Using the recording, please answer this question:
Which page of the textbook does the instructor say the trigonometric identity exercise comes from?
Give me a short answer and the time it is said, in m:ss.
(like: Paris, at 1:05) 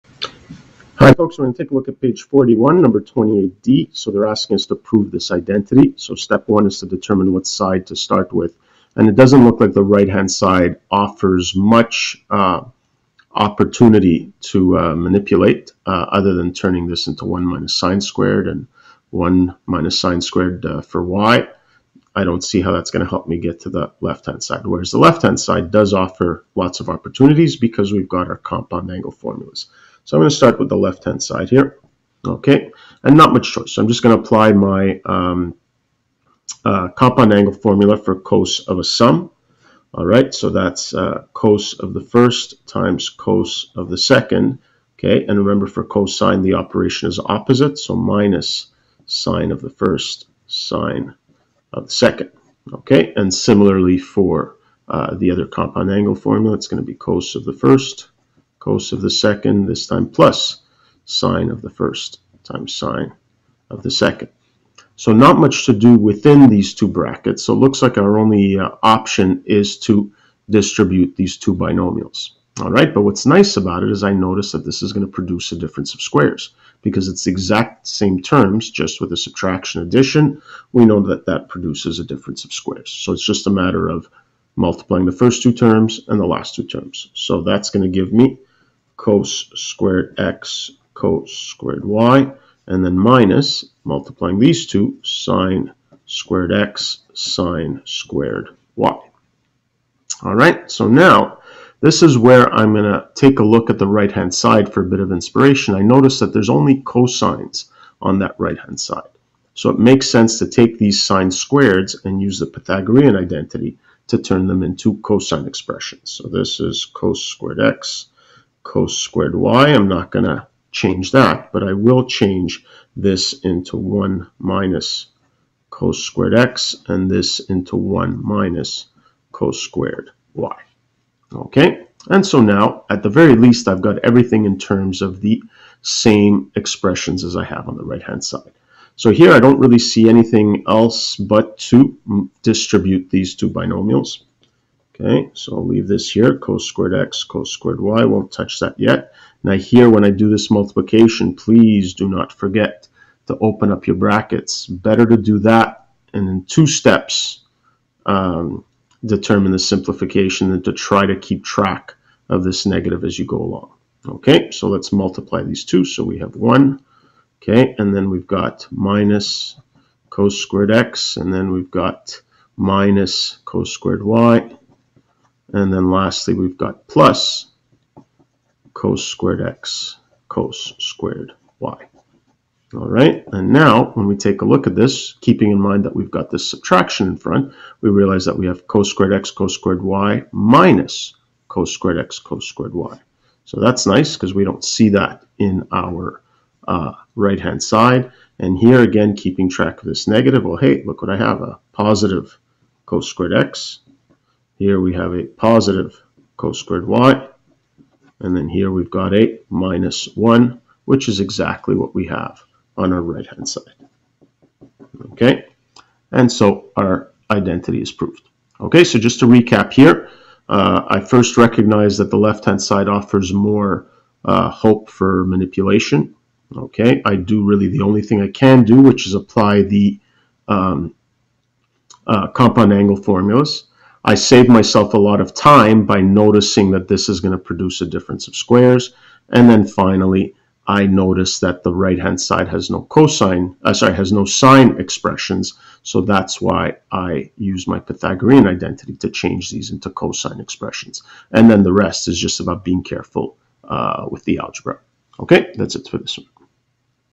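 41, at 0:01.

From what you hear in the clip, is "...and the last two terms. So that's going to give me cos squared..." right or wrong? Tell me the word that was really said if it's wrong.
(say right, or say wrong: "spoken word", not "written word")
right.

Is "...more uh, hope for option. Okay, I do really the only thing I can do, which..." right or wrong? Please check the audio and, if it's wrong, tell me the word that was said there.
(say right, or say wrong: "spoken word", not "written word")
wrong: "manipulation", not "option".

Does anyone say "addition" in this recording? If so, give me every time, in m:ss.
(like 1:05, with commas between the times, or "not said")
1:19.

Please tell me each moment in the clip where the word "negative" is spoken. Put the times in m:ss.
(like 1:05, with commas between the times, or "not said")
2:42, 3:20.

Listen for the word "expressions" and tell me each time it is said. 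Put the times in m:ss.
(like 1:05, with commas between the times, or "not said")
1:55, 2:16, 4:04, 4:10.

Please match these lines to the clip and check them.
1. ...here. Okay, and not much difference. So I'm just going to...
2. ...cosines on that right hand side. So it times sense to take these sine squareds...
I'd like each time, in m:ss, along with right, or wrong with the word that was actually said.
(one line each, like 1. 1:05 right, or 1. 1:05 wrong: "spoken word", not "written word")
1. 0:31 wrong: "choice", not "difference"
2. 1:46 wrong: "makes", not "times".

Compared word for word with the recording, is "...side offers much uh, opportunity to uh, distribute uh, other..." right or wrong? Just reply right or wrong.
wrong.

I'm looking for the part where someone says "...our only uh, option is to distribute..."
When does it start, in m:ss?
1:07.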